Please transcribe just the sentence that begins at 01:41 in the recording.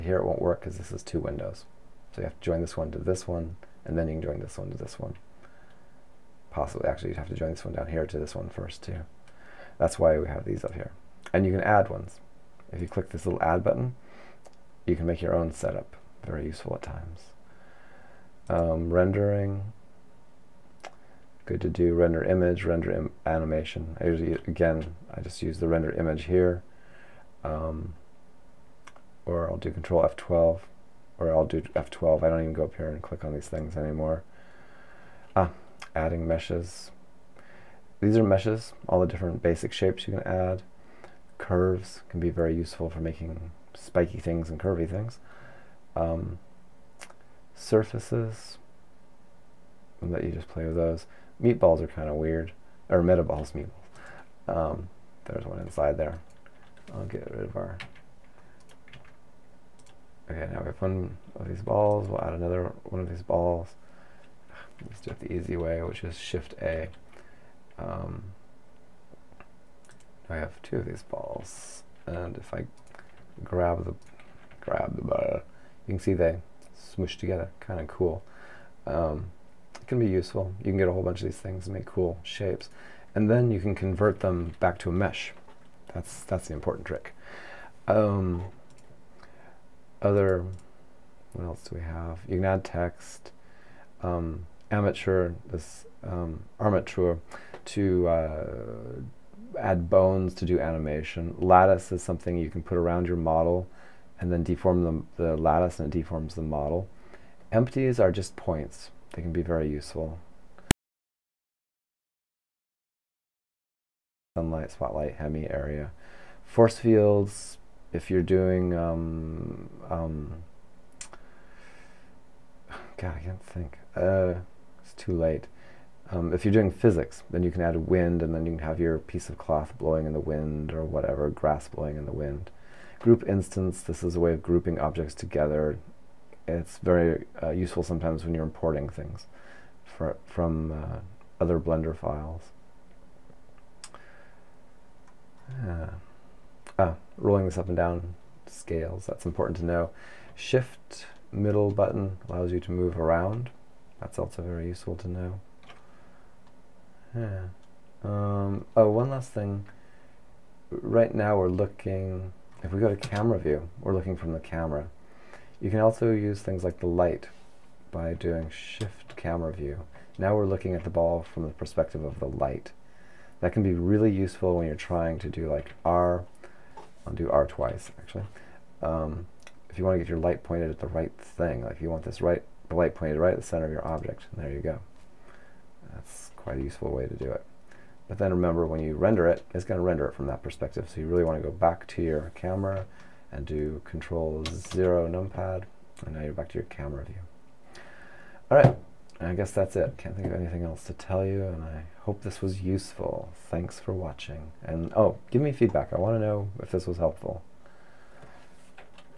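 Lattice is something you can put around your model and then deform the, the lattice and it deforms the model.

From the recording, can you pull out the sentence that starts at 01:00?
Okay, now we have one of these balls.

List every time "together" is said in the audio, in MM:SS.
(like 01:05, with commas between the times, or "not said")
01:17, 02:15.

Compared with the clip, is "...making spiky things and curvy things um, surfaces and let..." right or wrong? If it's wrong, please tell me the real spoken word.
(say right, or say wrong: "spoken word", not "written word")
right.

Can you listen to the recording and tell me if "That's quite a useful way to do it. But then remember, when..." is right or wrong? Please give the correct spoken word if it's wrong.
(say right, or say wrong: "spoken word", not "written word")
right.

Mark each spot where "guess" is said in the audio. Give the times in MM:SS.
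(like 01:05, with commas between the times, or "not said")
03:19.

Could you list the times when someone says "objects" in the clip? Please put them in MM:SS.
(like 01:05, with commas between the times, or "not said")
02:14, 03:03.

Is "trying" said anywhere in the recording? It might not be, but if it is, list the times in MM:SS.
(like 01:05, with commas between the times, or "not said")
02:54.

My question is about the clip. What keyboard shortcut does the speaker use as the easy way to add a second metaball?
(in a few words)
Shift-A.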